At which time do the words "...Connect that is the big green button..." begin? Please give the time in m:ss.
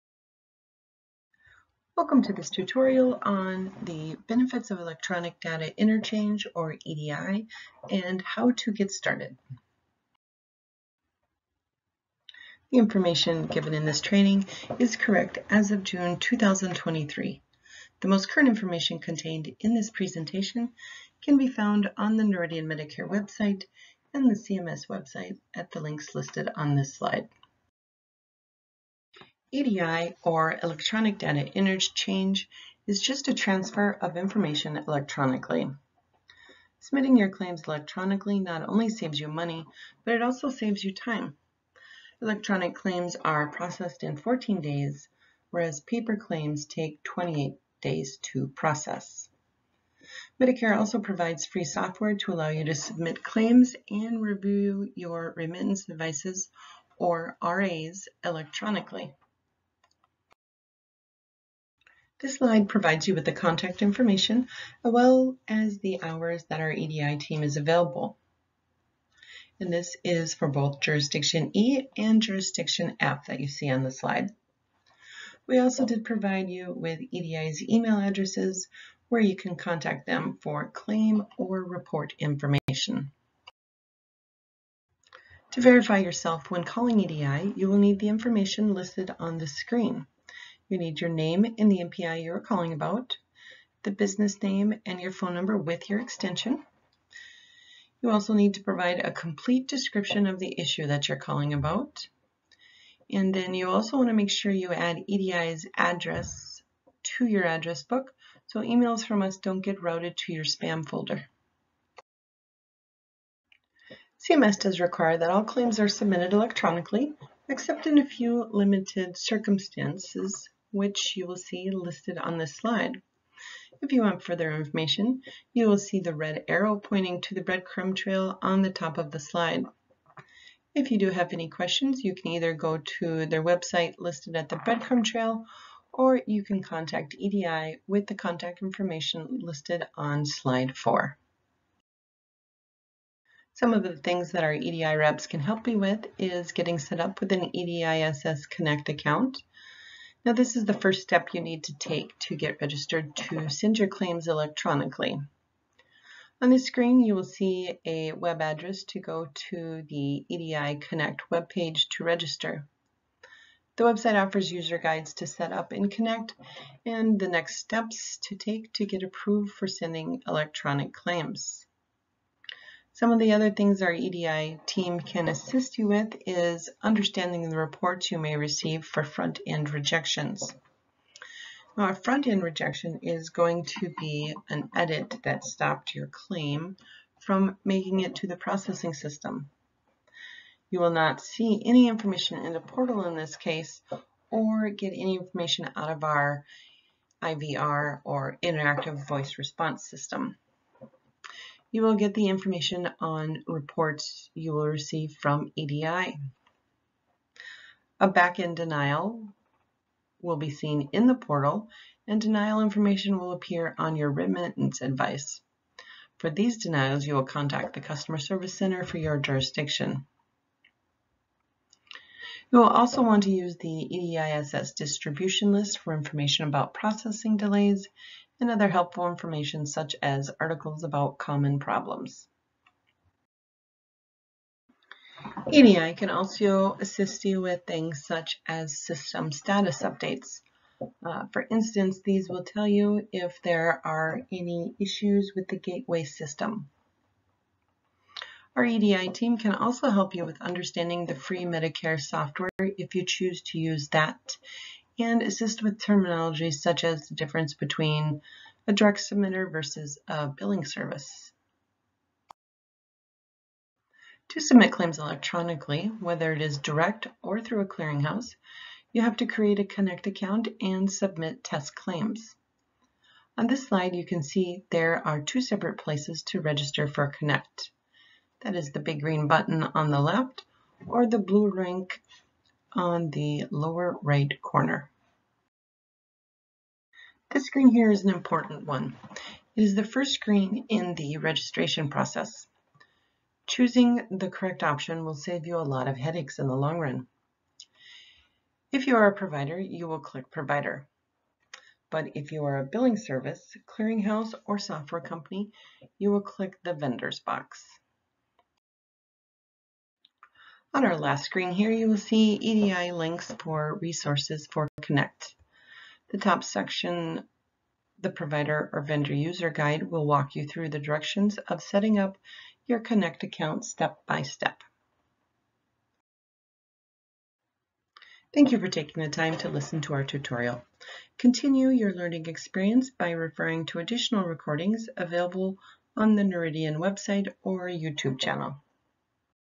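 4:37.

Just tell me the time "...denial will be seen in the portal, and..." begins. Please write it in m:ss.
3:28.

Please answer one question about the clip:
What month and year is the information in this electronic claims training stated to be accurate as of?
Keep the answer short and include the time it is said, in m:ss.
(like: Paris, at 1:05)
June 2023, at 0:15.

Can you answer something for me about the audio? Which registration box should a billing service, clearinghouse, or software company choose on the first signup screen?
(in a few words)
Vendors.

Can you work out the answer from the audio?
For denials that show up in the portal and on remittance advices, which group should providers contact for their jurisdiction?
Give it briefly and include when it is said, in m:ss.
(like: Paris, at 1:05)
Customer Service Center, at 3:37.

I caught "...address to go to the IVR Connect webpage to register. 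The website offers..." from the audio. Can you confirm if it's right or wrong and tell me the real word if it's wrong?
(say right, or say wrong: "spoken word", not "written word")
wrong: "EDI", not "IVR".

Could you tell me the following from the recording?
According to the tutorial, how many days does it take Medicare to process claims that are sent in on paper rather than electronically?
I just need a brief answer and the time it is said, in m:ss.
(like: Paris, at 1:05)
28 days, at 0:47.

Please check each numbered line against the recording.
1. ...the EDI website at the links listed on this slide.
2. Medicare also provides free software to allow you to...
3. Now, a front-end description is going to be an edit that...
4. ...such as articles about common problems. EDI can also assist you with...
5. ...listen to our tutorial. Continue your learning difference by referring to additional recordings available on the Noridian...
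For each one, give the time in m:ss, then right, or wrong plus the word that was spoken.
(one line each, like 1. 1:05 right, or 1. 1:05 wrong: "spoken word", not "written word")
1. 0:24 wrong: "CMS", not "EDI"
2. 0:50 right
3. 3:01 wrong: "rejection", not "description"
4. 3:49 right
5. 5:29 wrong: "experience", not "difference".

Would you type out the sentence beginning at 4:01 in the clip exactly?
Uh, for instance, these will tell you if there are any issues with the gateway system.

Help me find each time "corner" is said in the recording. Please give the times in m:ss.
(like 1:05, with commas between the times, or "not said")
4:44.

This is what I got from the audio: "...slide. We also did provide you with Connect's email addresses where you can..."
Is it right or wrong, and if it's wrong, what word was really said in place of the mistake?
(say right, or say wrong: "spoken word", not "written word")
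wrong: "EDI", not "Connect".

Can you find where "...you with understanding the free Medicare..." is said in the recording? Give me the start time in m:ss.
4:10.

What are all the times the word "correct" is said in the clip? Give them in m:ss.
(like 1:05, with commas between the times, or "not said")
0:14, 4:54.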